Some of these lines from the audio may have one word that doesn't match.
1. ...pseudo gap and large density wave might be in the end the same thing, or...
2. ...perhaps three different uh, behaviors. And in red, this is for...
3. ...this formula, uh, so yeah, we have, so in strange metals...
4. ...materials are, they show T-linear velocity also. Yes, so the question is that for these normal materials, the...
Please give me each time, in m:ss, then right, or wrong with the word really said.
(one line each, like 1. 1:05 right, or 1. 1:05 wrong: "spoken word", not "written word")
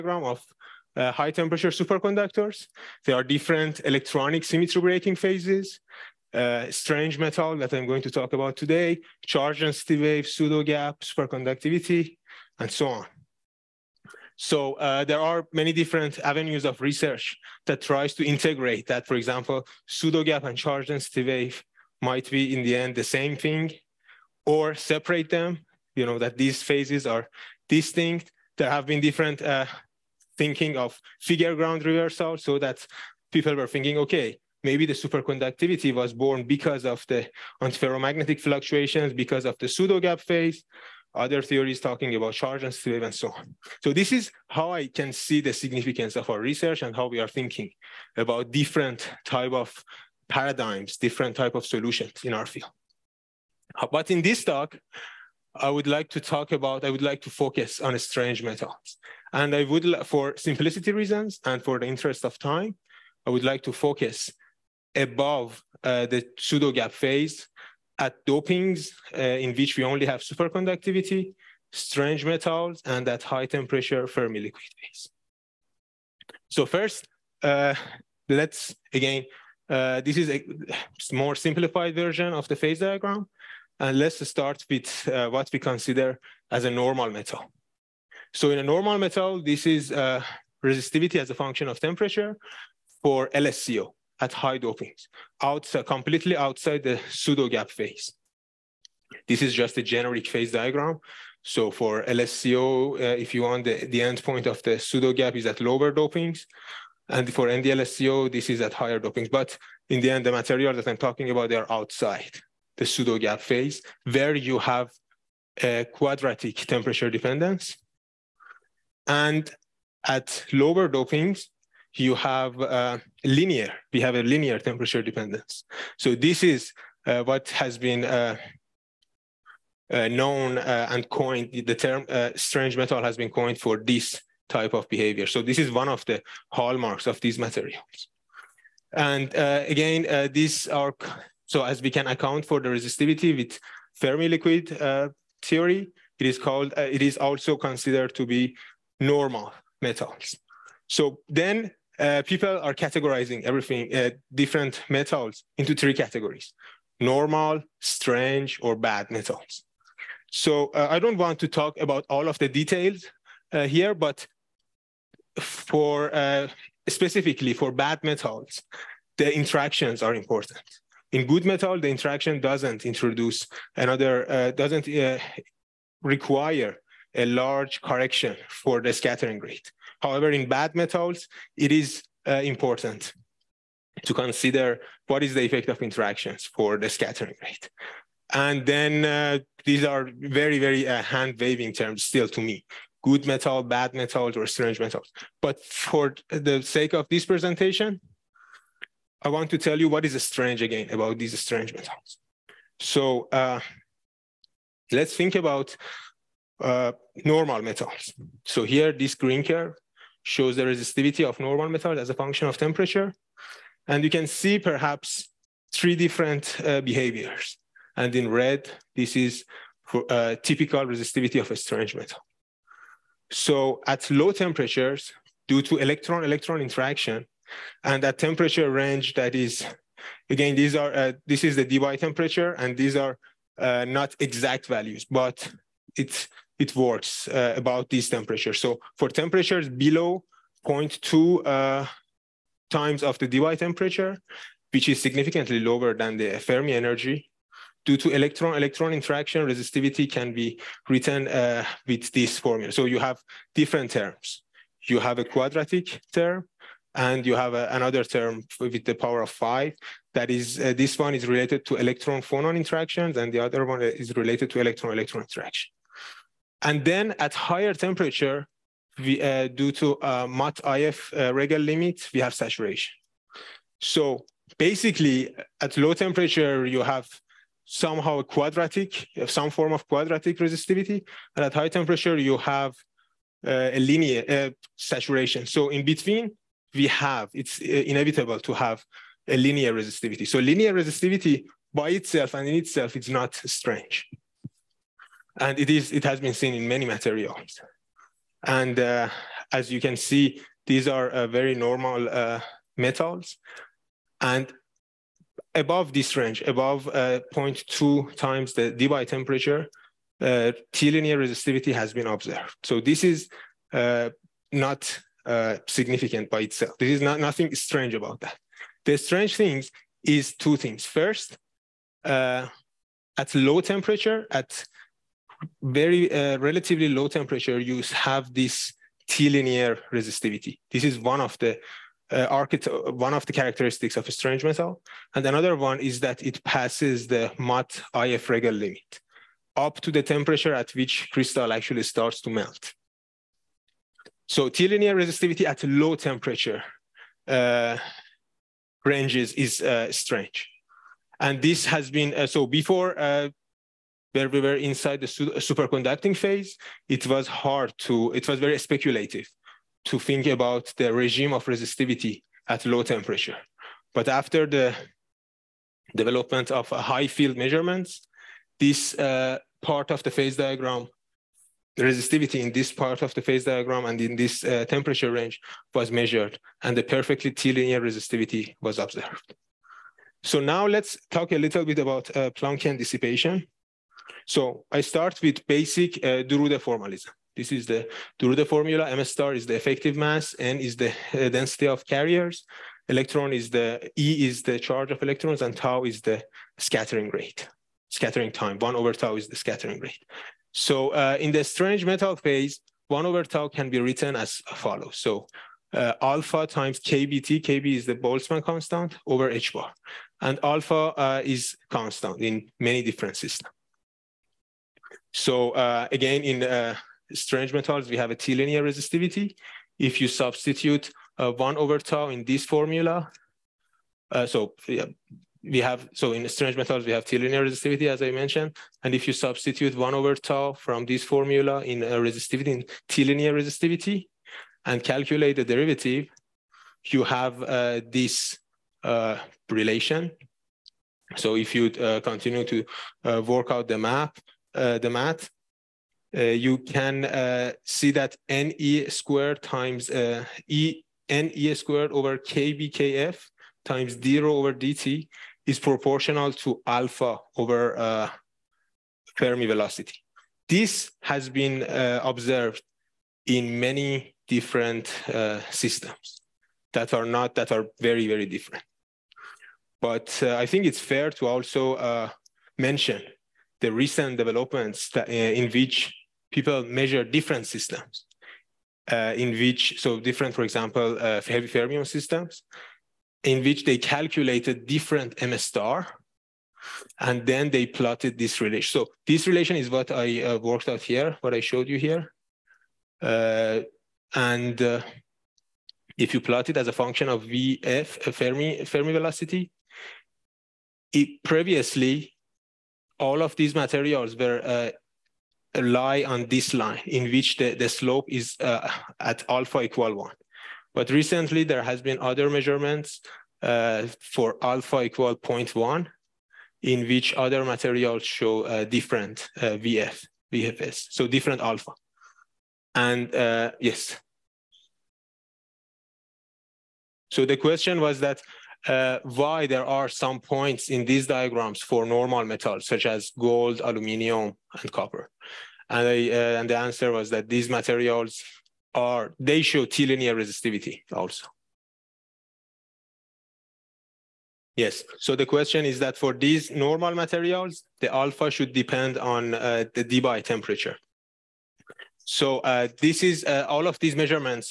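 1. 0:19 wrong: "charge", not "large"
2. 3:34 right
3. 7:02 right
4. 8:57 wrong: "resistivity", not "velocity".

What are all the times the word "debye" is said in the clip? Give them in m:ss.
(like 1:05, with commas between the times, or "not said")
3:51, 4:03, 5:08, 9:09.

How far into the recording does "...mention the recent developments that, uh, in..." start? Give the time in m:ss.
7:52.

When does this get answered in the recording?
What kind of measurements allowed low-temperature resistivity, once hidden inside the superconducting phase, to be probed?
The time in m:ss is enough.
6:06.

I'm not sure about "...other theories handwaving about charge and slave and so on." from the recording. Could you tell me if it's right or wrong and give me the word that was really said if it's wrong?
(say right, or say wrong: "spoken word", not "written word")
wrong: "talking", not "handwaving".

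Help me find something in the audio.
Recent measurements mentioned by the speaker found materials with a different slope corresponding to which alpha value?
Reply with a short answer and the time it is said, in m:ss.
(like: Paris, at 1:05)
0.1, at 8:35.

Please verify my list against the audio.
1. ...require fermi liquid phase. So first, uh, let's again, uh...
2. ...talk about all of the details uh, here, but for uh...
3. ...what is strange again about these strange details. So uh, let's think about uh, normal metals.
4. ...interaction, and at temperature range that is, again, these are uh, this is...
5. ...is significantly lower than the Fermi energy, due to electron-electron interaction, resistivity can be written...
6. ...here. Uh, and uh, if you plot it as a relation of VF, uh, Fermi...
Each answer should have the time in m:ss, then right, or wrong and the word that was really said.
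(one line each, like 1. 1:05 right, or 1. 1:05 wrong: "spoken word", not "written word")
1. 1:13 wrong: "temperature", not "require"
2. 2:41 right
3. 3:19 wrong: "metals", not "details"
4. 3:46 right
5. 4:04 right
6. 8:11 wrong: "function", not "relation".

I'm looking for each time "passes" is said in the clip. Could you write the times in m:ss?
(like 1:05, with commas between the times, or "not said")
5:36.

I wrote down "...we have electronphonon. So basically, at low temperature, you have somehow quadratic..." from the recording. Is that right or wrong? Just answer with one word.
wrong.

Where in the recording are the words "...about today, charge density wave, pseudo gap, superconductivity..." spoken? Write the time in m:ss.
0:08.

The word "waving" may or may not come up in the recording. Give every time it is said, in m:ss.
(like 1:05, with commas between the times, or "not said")
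3:11.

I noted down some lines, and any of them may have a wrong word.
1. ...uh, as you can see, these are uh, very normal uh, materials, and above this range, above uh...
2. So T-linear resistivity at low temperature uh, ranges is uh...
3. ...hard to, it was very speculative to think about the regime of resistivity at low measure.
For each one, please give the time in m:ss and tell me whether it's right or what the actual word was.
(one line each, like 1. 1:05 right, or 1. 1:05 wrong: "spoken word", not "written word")
1. 4:58 wrong: "metals", not "materials"
2. 5:44 right
3. 5:57 wrong: "temperature", not "measure".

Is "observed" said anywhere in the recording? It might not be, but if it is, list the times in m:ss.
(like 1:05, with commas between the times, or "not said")
5:12, 6:18, 7:42.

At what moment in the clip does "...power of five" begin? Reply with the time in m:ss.
4:18.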